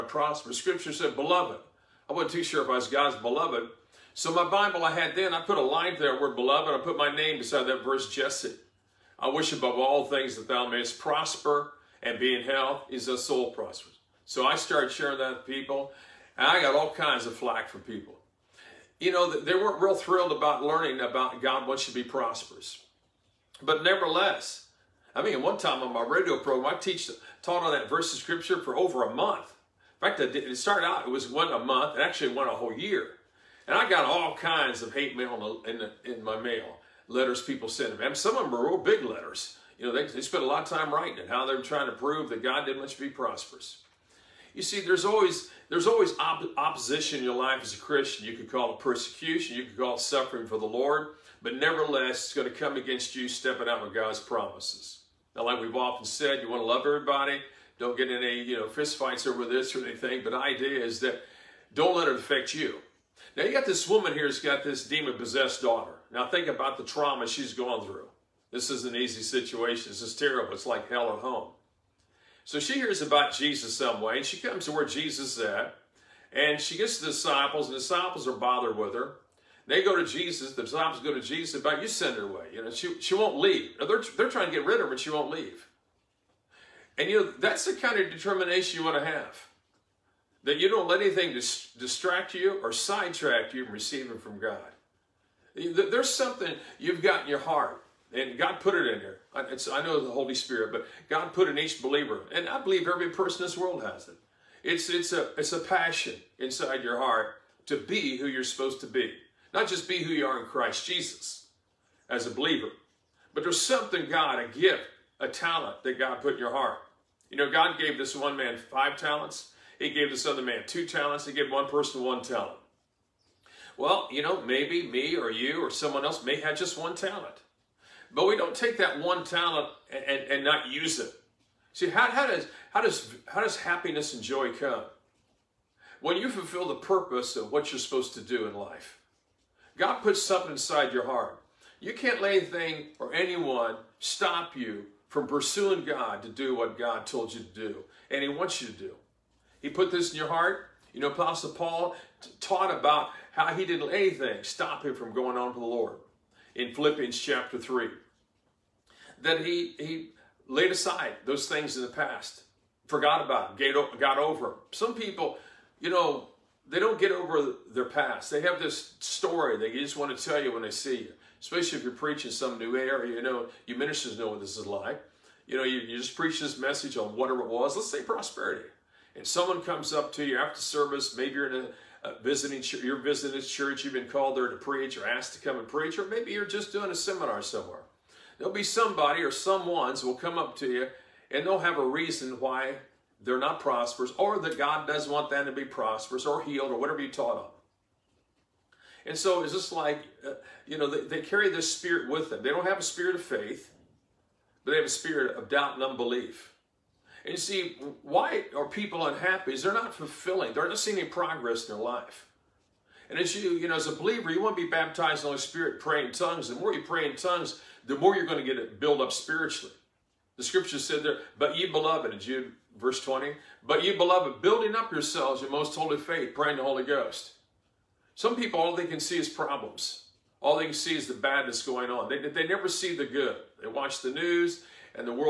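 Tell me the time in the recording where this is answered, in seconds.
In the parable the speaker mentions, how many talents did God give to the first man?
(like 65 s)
118 s.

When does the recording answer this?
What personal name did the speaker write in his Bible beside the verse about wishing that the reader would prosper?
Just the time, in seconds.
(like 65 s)
8 s.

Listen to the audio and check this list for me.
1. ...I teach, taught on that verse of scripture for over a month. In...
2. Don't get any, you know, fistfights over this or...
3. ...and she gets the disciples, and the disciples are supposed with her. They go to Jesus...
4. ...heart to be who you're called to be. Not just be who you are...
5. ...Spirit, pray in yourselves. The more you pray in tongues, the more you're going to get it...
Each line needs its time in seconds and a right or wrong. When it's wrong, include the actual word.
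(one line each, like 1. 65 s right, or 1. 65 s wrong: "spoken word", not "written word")
1. 26 s right
2. 57 s right
3. 76 s wrong: "bothered", not "supposed"
4. 106 s wrong: "supposed", not "called"
5. 215 s wrong: "tongues", not "yourselves".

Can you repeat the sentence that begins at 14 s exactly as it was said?
So I started sharing that with people, and I got all kinds of flack from people.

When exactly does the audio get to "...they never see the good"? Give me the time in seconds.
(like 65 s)
232 s.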